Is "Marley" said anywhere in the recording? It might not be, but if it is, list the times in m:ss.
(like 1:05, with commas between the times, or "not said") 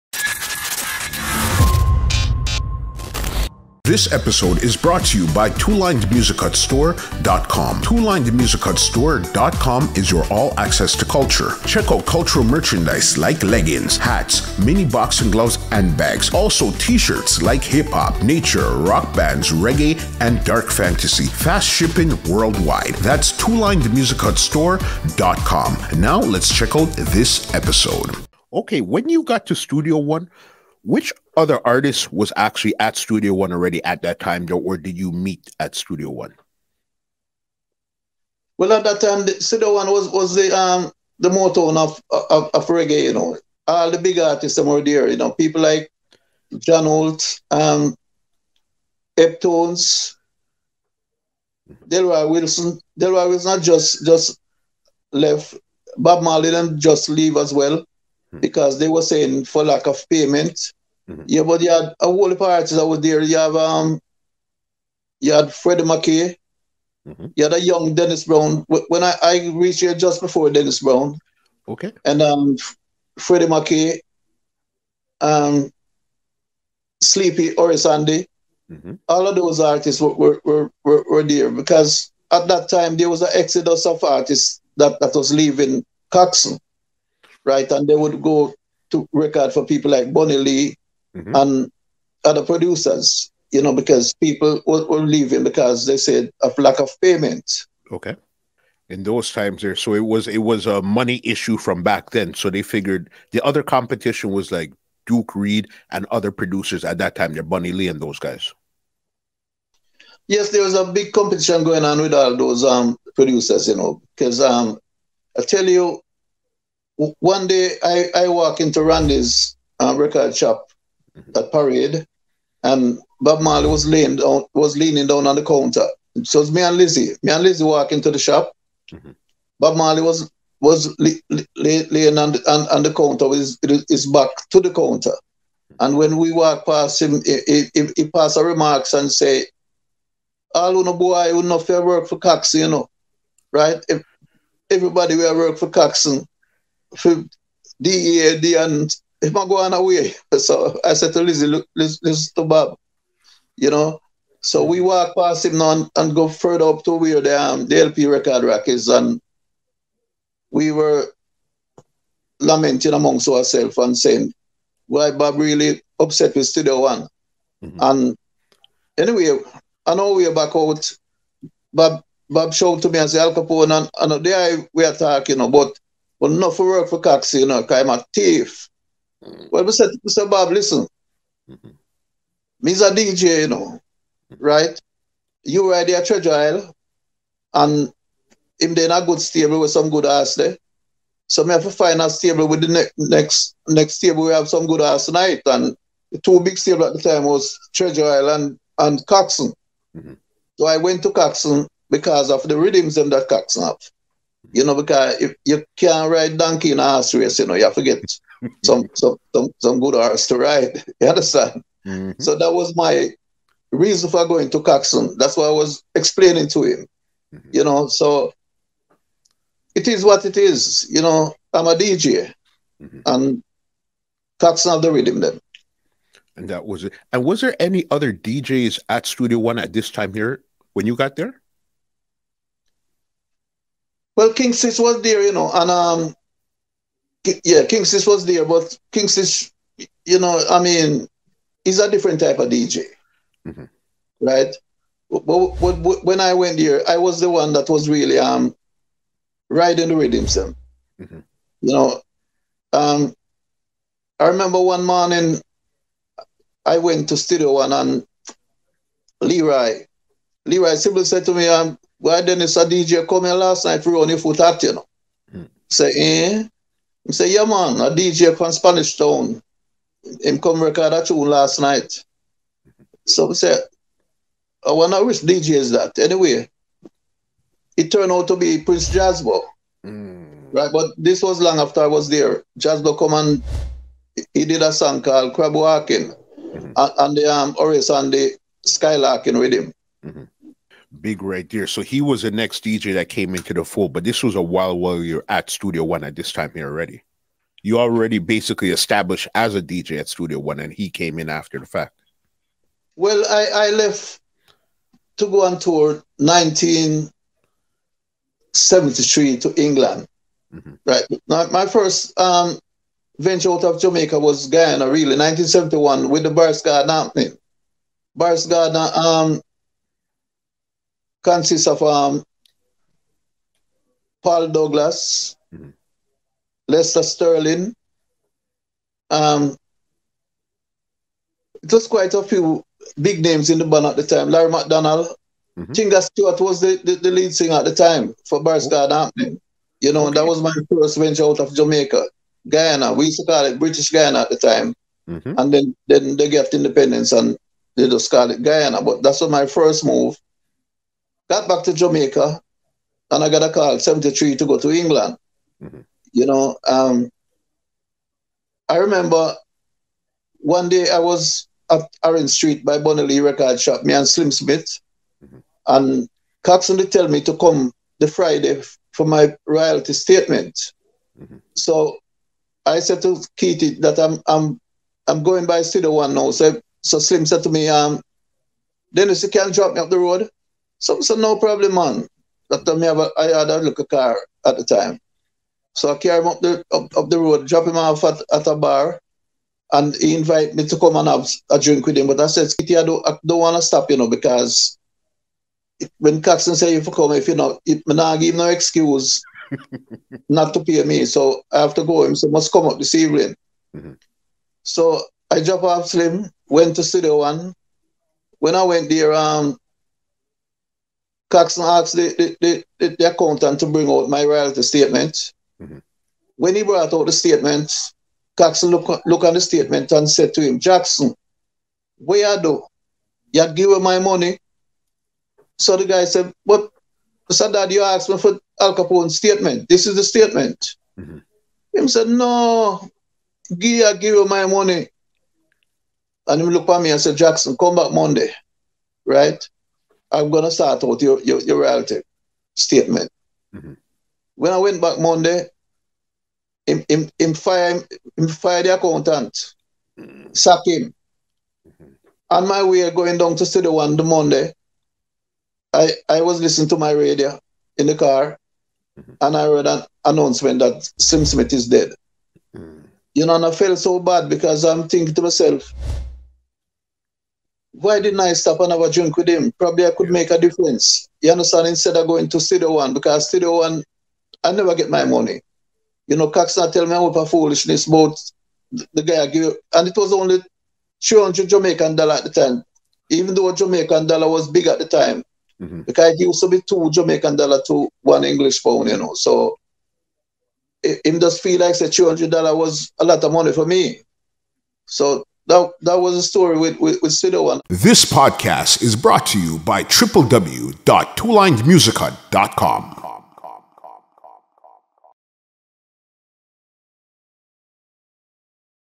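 0:56, 2:03, 2:09.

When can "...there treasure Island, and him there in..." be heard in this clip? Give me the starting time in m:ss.
3:05.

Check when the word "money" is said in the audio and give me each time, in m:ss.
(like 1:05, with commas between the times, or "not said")
1:40, 7:03, 7:14, 7:55, 8:13.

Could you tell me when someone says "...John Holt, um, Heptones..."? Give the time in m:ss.
0:46.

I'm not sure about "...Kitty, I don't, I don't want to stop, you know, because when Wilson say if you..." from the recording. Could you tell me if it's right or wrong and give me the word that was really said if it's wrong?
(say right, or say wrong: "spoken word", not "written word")
wrong: "Coxsone", not "Wilson".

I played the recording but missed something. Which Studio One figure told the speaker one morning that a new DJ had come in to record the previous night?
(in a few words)
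Leroy Sibbles.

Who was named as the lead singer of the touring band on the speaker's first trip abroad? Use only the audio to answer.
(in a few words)
Tinga Stewart.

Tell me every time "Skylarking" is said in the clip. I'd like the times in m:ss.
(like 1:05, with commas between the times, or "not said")
4:48.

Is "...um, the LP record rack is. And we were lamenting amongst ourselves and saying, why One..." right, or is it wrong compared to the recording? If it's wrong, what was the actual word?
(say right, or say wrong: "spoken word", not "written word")
wrong: "Bob", not "One".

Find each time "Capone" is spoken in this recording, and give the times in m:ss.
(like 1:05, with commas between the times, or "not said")
2:53, 7:08.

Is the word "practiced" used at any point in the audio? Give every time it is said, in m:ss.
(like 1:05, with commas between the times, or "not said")
not said.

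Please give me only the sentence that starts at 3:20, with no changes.
So I went to Coxsone because of the rhythms them that Coxsone have.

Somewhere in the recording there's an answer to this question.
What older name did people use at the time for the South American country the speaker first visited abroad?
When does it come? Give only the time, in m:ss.
5:43.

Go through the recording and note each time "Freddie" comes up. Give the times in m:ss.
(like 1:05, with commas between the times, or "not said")
1:05, 1:13.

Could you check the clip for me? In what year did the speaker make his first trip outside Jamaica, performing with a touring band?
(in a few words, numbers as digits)
1971.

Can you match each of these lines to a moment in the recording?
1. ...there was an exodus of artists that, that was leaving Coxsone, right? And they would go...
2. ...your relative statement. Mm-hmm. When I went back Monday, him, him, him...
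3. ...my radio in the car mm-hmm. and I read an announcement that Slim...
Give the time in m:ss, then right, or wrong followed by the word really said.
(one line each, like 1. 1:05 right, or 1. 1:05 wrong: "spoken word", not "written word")
1. 1:22 right
2. 7:21 right
3. 7:36 right.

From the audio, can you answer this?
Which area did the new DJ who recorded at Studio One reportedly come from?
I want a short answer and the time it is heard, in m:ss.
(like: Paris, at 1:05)
Spanish Town, at 4:28.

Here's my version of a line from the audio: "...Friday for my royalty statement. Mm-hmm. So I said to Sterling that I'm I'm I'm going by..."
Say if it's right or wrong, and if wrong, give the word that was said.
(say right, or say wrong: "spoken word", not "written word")
wrong: "Kitty", not "Sterling".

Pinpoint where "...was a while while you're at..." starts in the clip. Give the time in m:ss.
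4:54.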